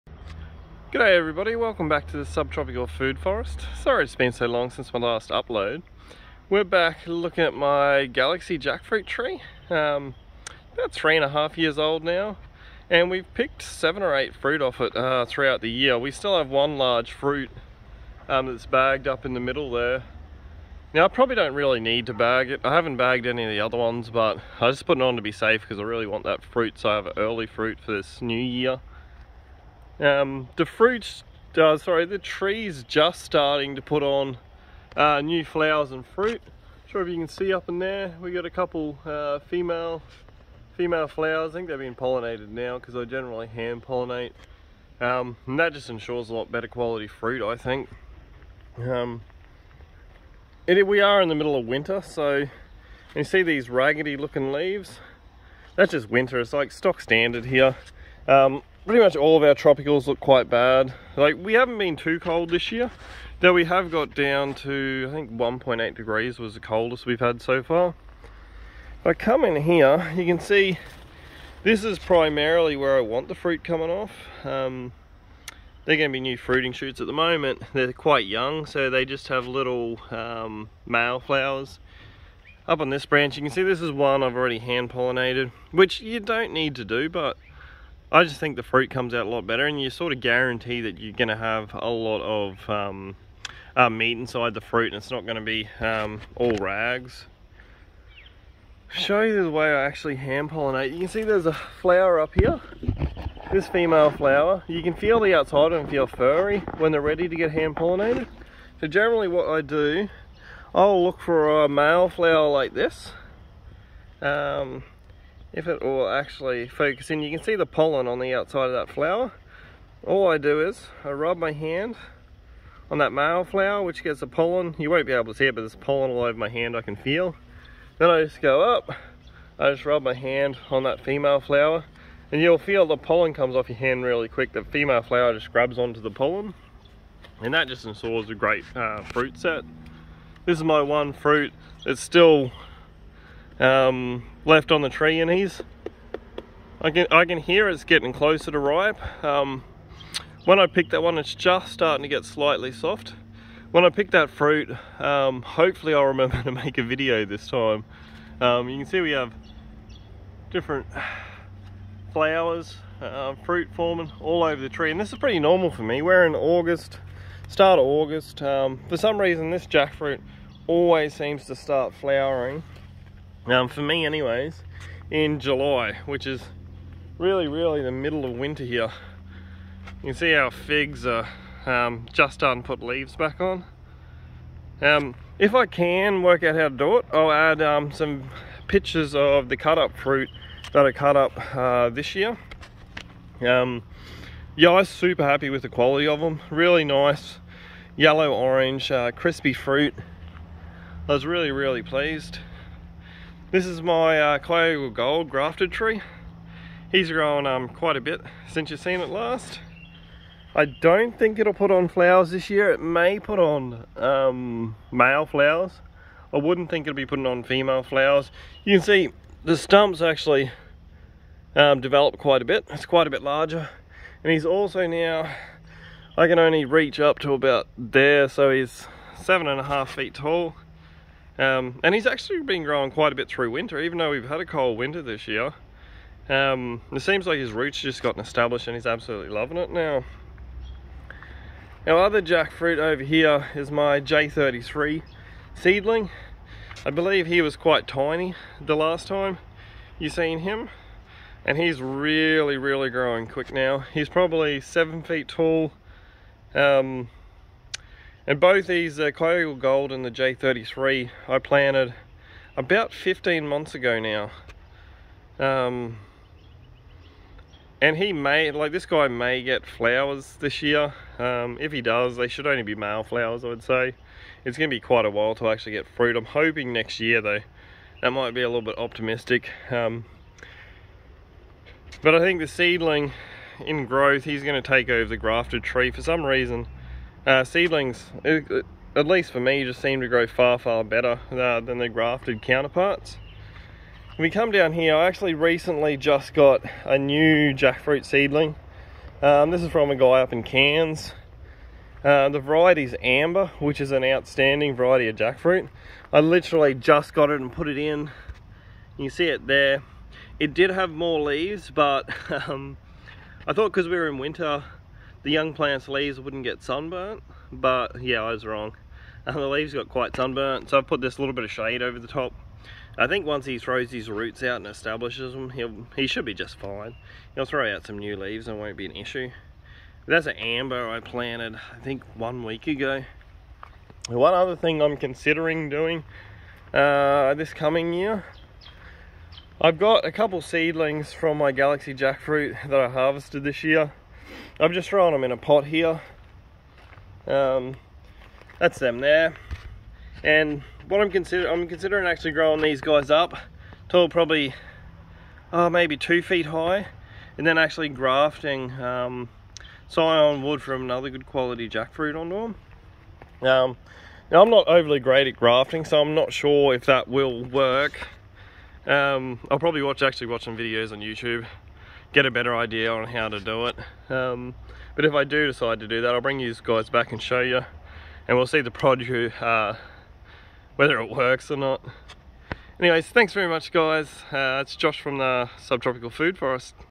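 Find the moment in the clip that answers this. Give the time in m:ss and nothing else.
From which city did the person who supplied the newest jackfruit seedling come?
5:00.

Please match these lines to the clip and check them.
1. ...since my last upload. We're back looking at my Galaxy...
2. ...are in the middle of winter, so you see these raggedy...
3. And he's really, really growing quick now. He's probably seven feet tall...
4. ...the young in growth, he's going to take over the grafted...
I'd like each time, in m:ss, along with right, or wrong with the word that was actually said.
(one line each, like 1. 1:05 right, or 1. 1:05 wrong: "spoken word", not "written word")
1. 0:04 right
2. 0:50 right
3. 4:11 right
4. 4:42 wrong: "seedling", not "young".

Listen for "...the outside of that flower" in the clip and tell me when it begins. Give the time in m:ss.
1:58.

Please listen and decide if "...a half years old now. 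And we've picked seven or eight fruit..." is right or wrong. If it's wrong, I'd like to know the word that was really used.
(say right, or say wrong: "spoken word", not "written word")
right.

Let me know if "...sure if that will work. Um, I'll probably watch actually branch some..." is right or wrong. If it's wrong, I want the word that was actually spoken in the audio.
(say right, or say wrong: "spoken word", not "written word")
wrong: "watch", not "branch".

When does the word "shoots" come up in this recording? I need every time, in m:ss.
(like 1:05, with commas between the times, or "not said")
1:16.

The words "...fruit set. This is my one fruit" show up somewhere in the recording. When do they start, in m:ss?
2:19.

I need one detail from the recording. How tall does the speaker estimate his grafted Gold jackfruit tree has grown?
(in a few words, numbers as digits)
7.5 feet.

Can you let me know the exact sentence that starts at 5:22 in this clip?
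I think once he throws his roots out and establishes them, he'll, he should be just fine.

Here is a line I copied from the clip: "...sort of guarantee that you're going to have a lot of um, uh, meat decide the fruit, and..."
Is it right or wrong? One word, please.
wrong.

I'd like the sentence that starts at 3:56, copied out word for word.
Um, it seems like his roots just gotten established and he's absolutely loving it now.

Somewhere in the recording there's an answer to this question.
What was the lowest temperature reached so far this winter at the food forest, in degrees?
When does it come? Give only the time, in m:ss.
1:05.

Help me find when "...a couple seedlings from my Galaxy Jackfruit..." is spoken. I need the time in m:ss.
5:40.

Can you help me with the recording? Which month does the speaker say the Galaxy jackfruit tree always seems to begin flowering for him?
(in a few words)
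July.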